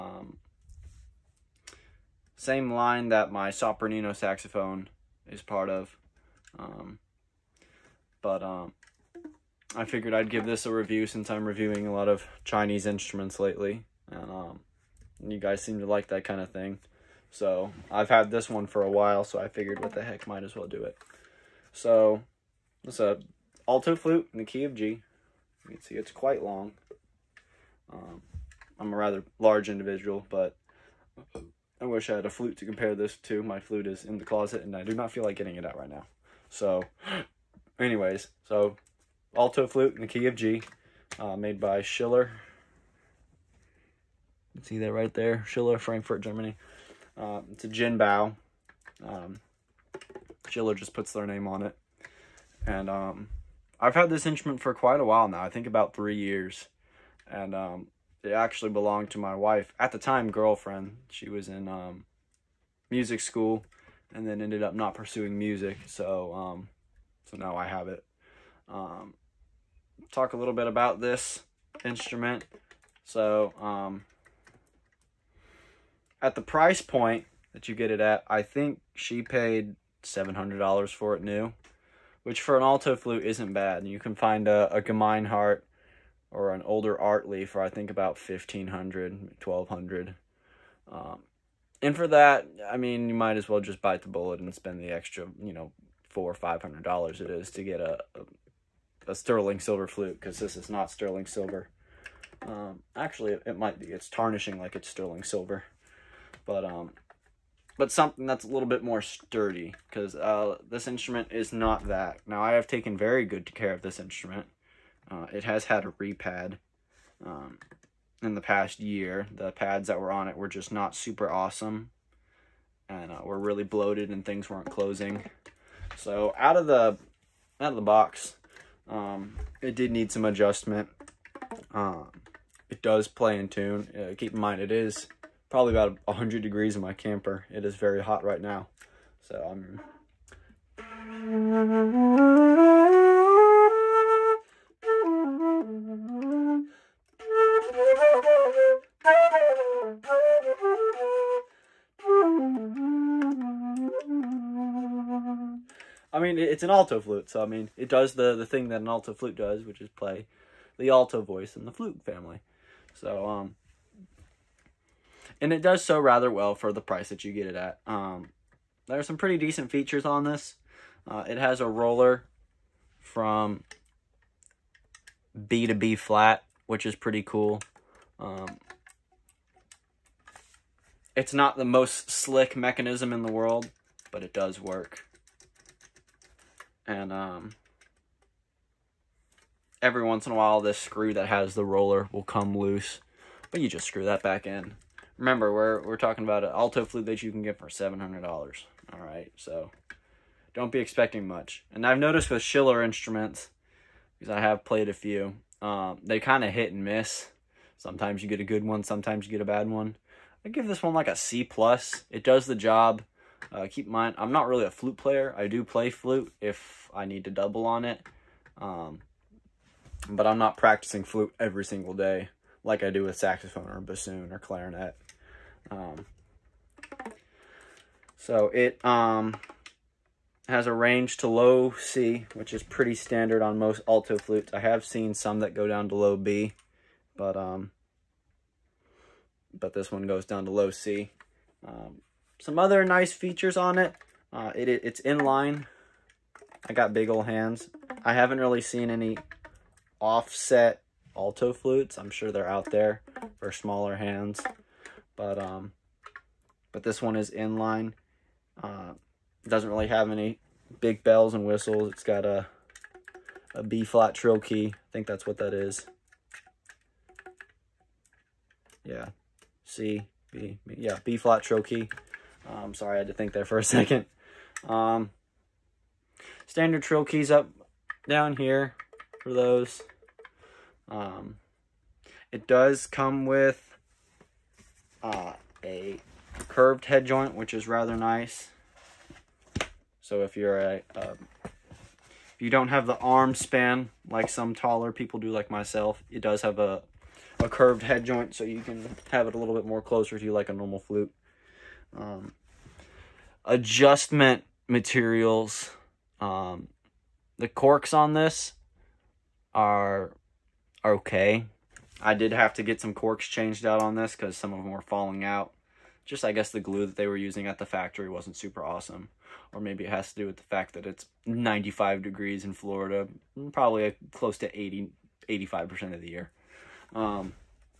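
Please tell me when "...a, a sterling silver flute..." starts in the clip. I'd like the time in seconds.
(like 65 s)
99 s.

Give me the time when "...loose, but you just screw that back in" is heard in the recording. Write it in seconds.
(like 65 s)
192 s.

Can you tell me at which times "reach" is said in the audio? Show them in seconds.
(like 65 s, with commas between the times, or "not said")
not said.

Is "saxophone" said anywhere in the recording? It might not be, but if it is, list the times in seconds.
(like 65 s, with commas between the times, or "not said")
4 s, 223 s.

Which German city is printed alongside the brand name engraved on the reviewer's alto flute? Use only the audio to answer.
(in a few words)
Frankfurt.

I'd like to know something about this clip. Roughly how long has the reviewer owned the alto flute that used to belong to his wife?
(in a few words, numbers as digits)
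3 years.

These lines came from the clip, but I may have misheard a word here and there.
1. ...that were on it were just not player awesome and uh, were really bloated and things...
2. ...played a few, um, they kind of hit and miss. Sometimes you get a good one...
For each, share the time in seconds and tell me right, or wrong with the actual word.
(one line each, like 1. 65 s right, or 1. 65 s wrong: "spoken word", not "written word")
1. 119 s wrong: "super", not "player"
2. 204 s right.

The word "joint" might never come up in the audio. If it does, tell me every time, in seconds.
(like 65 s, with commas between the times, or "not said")
287 s, 298 s.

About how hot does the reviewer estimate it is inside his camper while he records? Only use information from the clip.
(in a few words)
100 degrees.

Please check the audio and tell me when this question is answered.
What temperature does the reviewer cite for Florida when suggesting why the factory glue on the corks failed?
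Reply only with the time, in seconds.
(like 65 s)
321 s.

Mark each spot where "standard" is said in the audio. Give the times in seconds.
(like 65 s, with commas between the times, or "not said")
232 s, 276 s.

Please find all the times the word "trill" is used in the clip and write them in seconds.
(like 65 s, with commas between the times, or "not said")
264 s, 271 s, 276 s.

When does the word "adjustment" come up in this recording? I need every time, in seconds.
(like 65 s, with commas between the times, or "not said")
130 s, 303 s.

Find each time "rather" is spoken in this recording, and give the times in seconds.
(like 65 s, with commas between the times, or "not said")
28 s, 165 s, 287 s.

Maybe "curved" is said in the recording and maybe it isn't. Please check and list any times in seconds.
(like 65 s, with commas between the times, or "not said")
286 s, 297 s.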